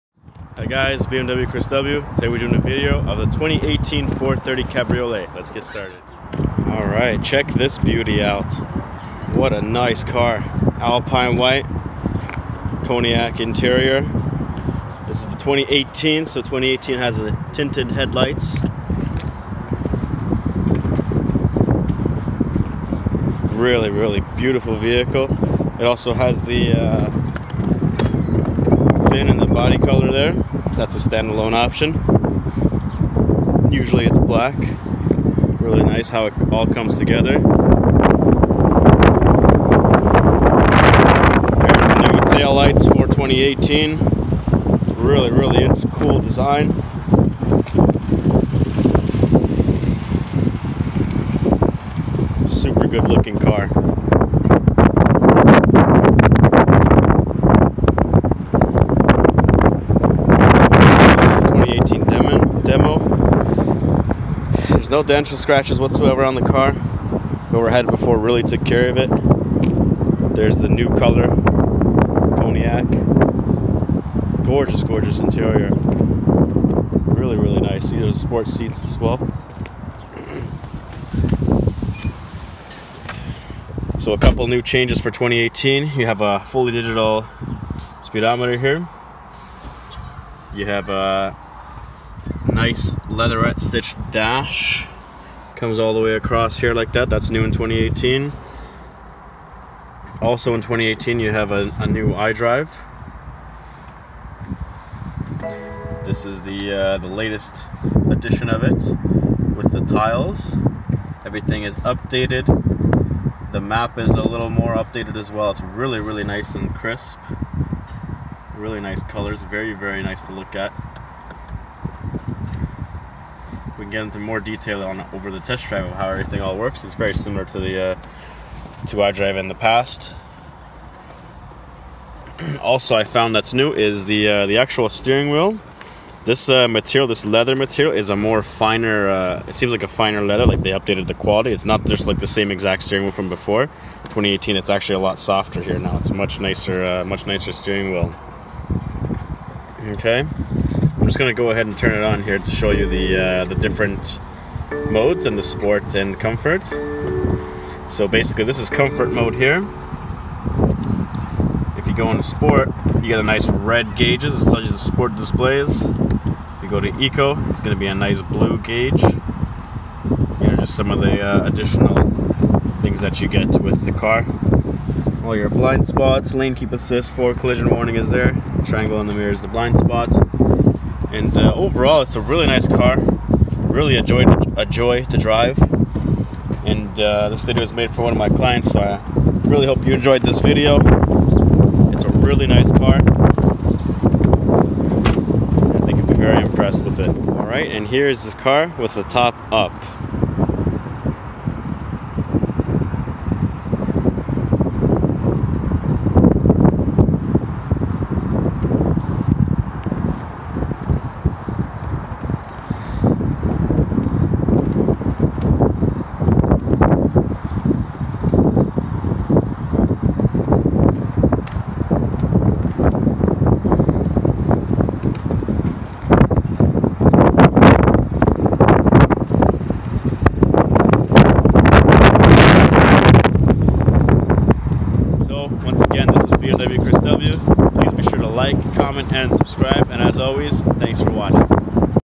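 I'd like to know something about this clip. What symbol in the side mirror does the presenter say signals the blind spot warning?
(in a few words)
Triangle.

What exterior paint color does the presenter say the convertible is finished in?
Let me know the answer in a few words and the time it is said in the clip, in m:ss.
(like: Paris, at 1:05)
Alpine white, at 0:10.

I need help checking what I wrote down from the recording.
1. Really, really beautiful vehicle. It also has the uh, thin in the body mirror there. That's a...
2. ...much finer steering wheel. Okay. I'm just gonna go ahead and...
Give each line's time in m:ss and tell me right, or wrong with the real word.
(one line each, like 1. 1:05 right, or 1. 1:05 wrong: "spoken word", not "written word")
1. 0:23 wrong: "color", not "mirror"
2. 2:27 wrong: "nicer", not "finer".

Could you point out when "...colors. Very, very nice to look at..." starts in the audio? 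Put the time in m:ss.
1:59.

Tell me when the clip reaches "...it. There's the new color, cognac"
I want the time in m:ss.
1:08.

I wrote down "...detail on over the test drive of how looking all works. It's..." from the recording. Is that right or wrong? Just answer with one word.
wrong.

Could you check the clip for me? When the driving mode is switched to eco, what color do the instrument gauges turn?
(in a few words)
Blue.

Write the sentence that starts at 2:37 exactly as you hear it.
So basically this is comfort mode here.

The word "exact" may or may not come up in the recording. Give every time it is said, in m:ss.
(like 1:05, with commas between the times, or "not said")
2:22.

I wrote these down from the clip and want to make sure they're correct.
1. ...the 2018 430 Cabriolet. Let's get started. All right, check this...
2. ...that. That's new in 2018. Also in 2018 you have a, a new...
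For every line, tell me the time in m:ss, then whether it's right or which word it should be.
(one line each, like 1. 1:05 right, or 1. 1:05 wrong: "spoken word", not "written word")
1. 0:03 right
2. 1:36 right.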